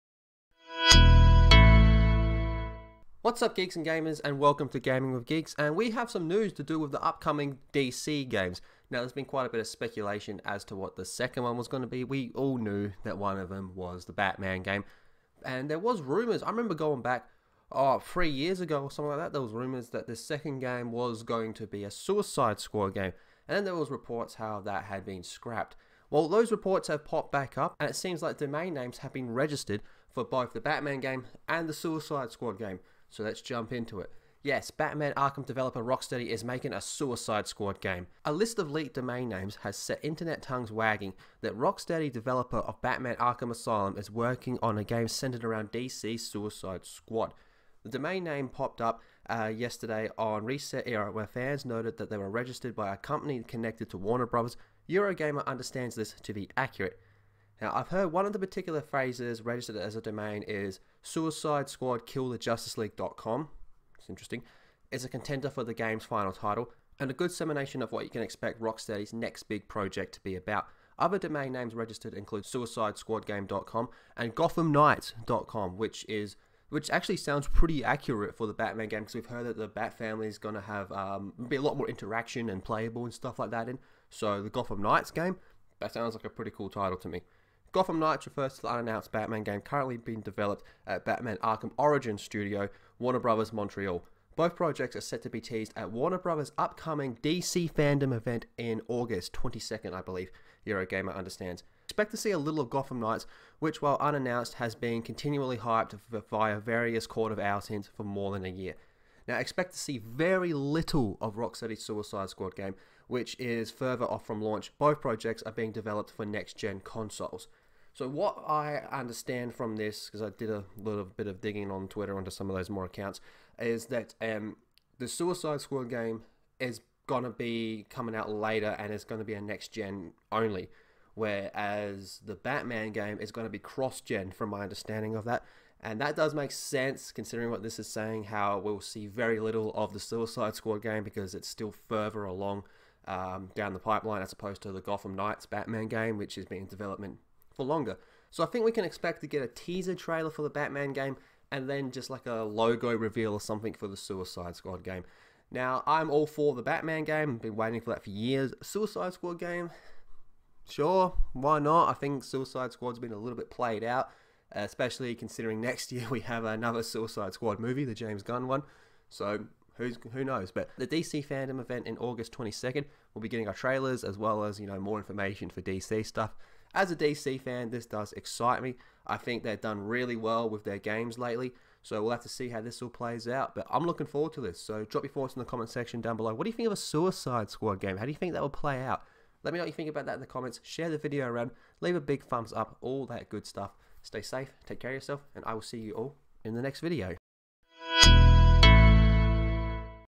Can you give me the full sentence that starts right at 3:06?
What do you think of a Suicide Squad game?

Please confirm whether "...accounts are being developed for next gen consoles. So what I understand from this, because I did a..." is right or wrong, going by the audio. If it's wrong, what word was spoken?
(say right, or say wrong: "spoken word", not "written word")
wrong: "projects", not "accounts".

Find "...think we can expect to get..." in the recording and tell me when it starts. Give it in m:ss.
2:28.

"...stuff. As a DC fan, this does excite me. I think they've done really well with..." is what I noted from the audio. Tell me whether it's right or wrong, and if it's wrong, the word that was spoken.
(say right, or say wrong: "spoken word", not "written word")
right.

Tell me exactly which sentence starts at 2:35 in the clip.
Now, I'm all for the Batman game, been waiting for that for years.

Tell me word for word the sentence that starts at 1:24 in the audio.
So the Gotham Knights game, that sounds like a pretty cool title to me.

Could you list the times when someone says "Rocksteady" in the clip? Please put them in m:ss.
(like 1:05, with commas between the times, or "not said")
0:35, 0:41, 1:08, 1:51.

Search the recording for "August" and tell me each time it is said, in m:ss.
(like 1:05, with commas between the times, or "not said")
1:38, 2:51.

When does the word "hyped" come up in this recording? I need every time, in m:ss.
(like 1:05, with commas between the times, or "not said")
1:45.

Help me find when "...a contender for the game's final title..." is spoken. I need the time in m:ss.
1:05.